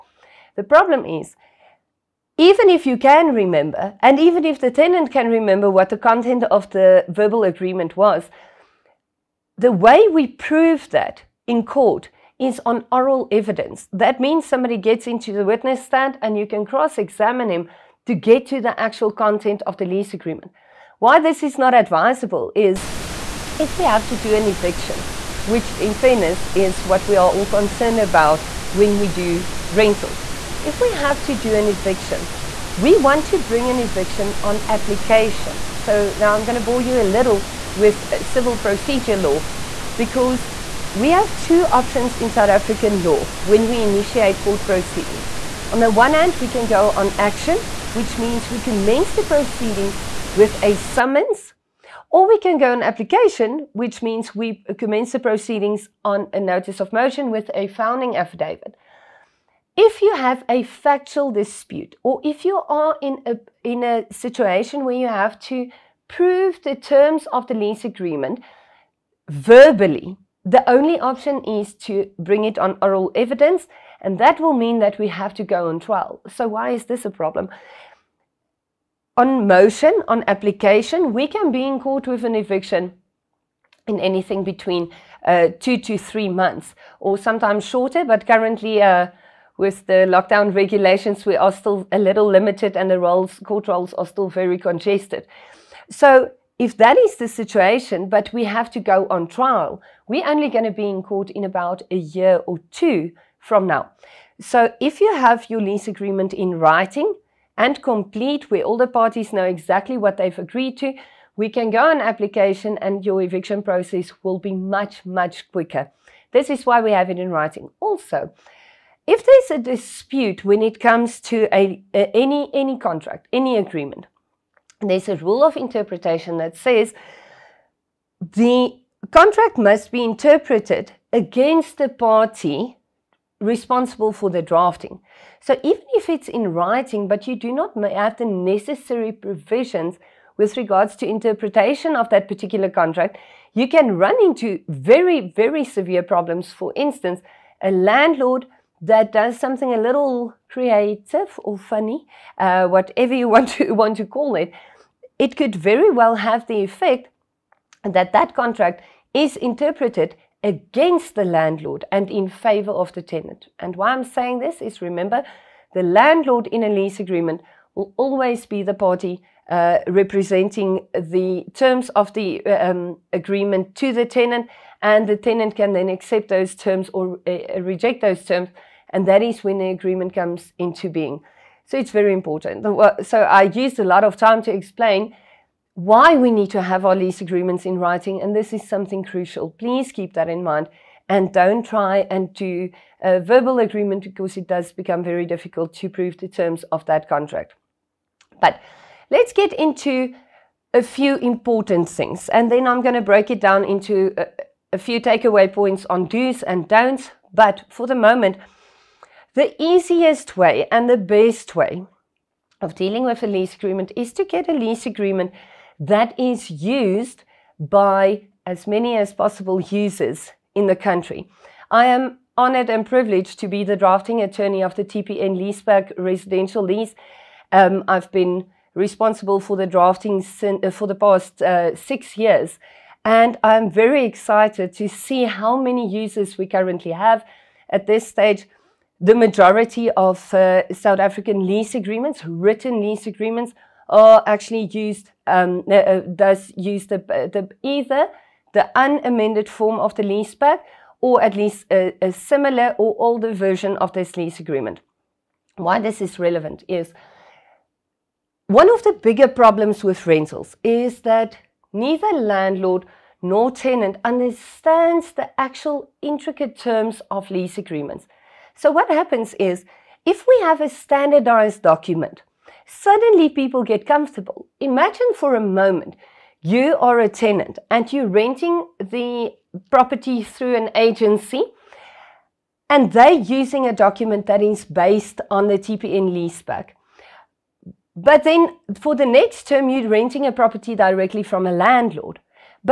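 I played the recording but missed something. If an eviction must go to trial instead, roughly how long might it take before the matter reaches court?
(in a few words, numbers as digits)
A year or two.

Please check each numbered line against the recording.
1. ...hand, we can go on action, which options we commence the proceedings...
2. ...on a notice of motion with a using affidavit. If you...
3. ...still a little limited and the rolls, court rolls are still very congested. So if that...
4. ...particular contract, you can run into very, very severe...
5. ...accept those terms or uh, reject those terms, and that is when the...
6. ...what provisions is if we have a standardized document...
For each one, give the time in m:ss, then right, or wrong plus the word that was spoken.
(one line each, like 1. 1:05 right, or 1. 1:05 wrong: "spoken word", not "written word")
1. 0:46 wrong: "means", not "options"
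2. 0:56 wrong: "founding", not "using"
3. 1:31 right
4. 2:22 right
5. 2:55 right
6. 4:28 wrong: "happens", not "provisions".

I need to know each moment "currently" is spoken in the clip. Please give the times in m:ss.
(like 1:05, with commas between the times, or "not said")
1:28, 3:56.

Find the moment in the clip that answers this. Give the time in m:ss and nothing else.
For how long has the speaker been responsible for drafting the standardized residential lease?
3:51.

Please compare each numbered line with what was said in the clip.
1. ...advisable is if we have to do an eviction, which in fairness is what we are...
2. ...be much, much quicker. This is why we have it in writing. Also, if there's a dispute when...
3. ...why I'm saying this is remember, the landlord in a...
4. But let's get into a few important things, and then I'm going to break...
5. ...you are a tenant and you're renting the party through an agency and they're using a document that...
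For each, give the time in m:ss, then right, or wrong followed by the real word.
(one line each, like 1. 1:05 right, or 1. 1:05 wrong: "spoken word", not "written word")
1. 0:21 right
2. 1:54 right
3. 2:43 right
4. 3:18 right
5. 4:36 wrong: "property", not "party".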